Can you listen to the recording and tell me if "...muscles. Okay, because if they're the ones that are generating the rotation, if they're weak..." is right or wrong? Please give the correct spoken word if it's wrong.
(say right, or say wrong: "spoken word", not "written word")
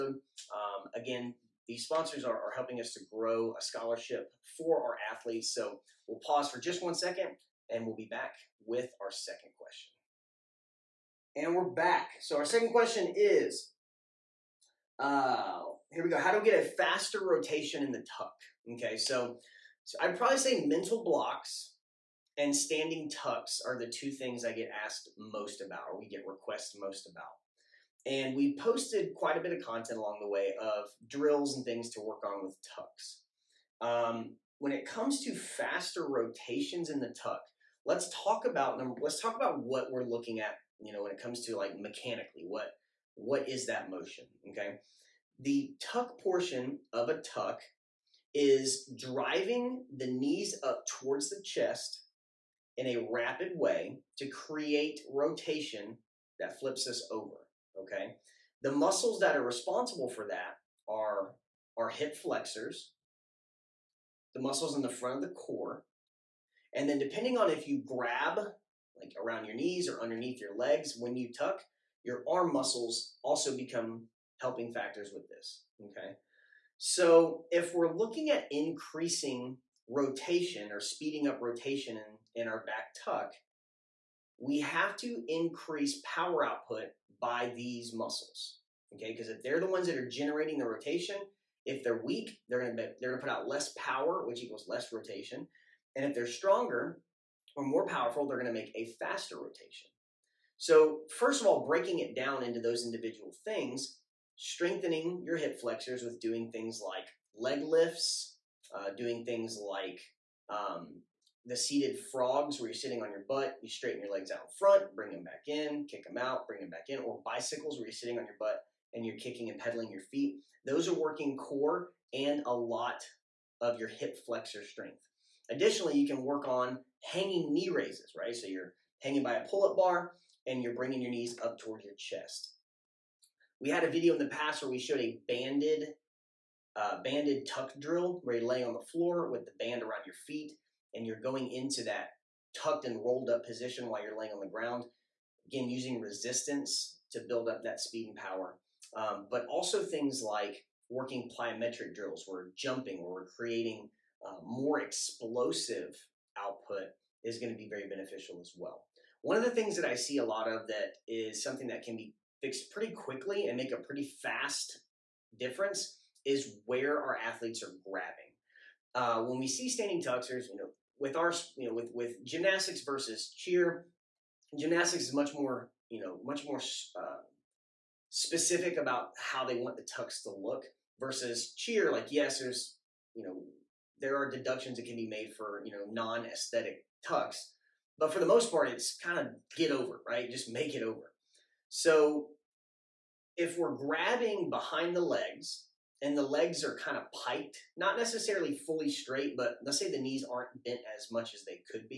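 right.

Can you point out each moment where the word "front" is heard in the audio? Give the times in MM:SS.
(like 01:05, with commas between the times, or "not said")
01:04, 01:54.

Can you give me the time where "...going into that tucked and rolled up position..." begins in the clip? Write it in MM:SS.
02:21.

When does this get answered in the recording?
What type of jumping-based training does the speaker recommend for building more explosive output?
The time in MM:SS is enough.
02:31.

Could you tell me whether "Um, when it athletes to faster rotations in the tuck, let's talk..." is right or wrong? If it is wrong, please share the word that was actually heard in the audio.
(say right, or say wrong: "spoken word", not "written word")
wrong: "comes", not "athletes".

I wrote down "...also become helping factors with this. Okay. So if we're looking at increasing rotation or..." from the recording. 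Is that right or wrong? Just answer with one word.
right.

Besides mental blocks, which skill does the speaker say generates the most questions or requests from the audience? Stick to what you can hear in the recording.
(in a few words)
Standing tucks.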